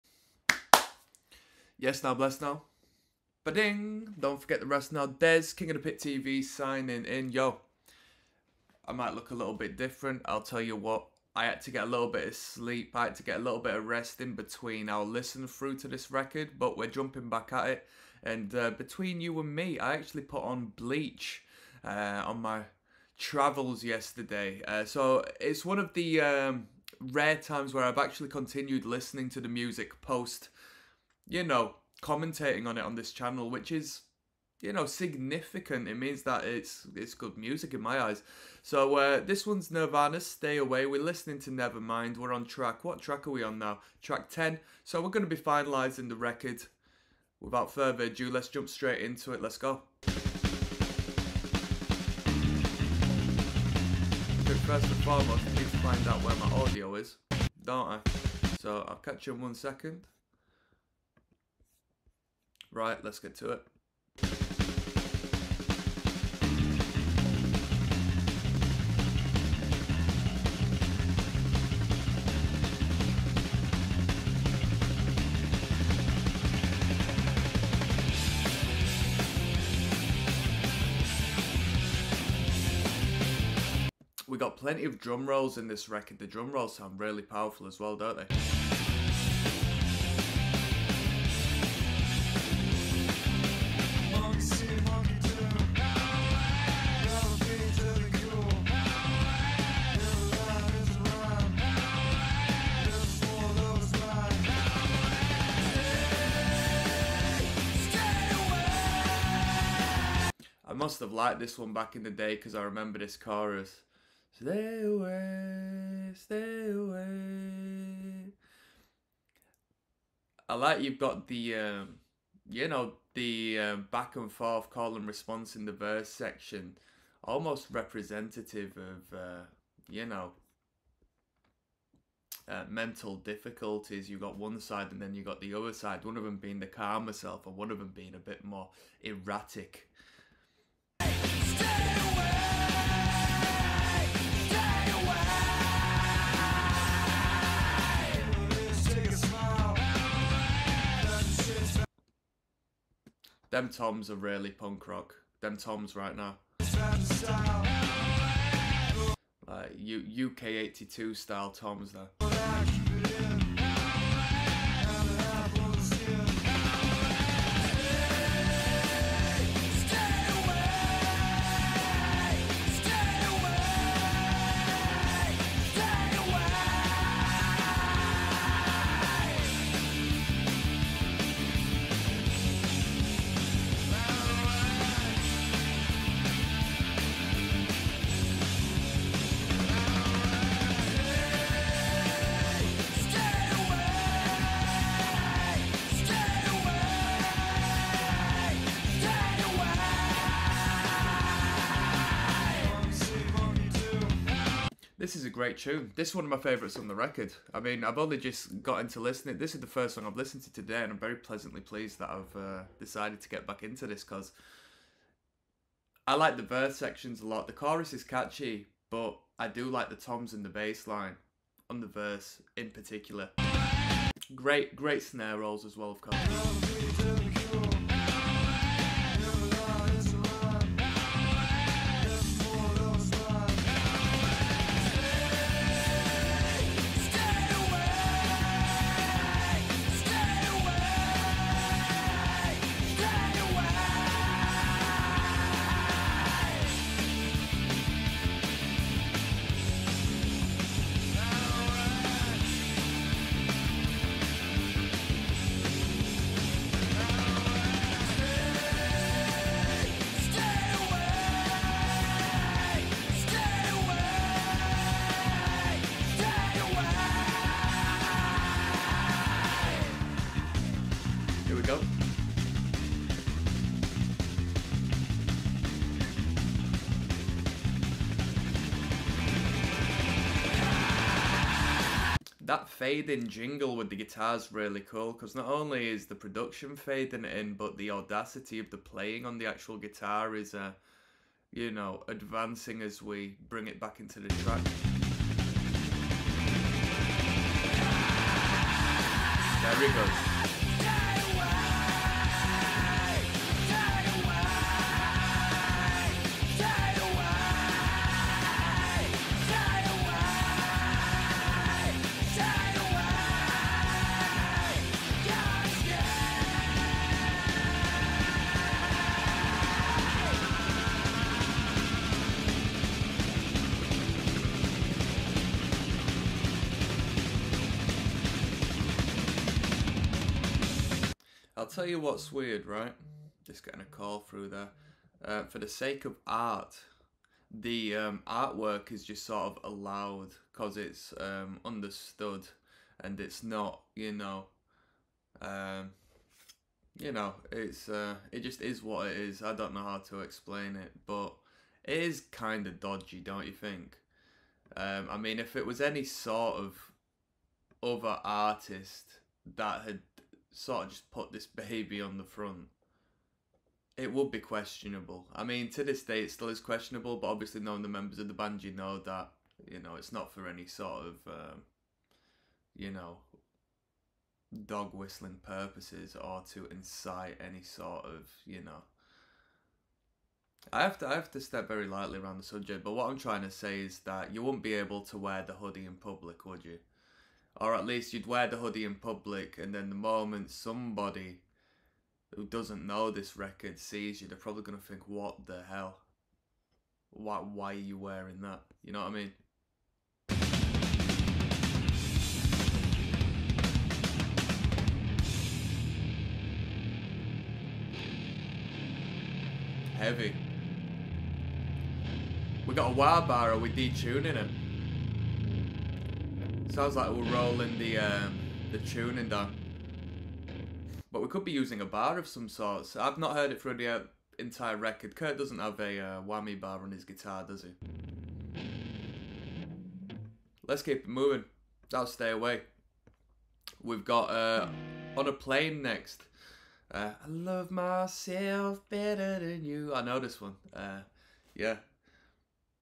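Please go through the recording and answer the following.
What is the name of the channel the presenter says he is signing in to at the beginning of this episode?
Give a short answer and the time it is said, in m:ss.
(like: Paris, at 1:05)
King of the Pit TV, at 0:05.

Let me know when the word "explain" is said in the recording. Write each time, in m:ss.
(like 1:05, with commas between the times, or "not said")
5:50.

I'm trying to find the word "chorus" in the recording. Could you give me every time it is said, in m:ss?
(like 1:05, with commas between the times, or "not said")
1:53, 3:37.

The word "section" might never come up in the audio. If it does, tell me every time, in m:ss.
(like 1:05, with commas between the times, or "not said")
2:06, 3:36.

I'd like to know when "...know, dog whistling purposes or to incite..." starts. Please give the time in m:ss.
6:12.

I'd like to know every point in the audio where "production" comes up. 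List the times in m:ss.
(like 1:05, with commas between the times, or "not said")
4:46.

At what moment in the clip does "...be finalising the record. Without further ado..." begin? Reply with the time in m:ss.
0:45.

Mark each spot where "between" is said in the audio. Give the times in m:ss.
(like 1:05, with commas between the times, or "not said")
0:14, 0:18.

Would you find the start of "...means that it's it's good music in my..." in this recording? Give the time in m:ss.
0:35.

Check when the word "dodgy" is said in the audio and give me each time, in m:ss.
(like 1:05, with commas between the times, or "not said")
5:52.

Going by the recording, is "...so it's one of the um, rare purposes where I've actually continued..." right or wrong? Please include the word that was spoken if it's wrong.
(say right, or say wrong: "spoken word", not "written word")
wrong: "times", not "purposes".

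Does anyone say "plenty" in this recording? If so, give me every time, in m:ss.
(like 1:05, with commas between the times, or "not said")
1:24.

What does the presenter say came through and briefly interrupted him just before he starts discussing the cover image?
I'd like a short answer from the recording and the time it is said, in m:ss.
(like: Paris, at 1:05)
a call, at 5:33.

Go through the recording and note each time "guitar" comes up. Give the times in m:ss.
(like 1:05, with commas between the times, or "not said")
4:43, 4:49, 7:07.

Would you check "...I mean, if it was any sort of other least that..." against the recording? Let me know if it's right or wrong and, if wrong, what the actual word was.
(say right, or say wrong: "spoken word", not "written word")
wrong: "artist", not "least".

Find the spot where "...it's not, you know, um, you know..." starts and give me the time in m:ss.
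5:43.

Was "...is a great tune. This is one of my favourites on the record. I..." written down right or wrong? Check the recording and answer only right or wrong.
right.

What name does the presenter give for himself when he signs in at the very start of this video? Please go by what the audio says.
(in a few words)
Dez.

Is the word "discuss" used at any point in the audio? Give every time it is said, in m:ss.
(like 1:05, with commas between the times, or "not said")
not said.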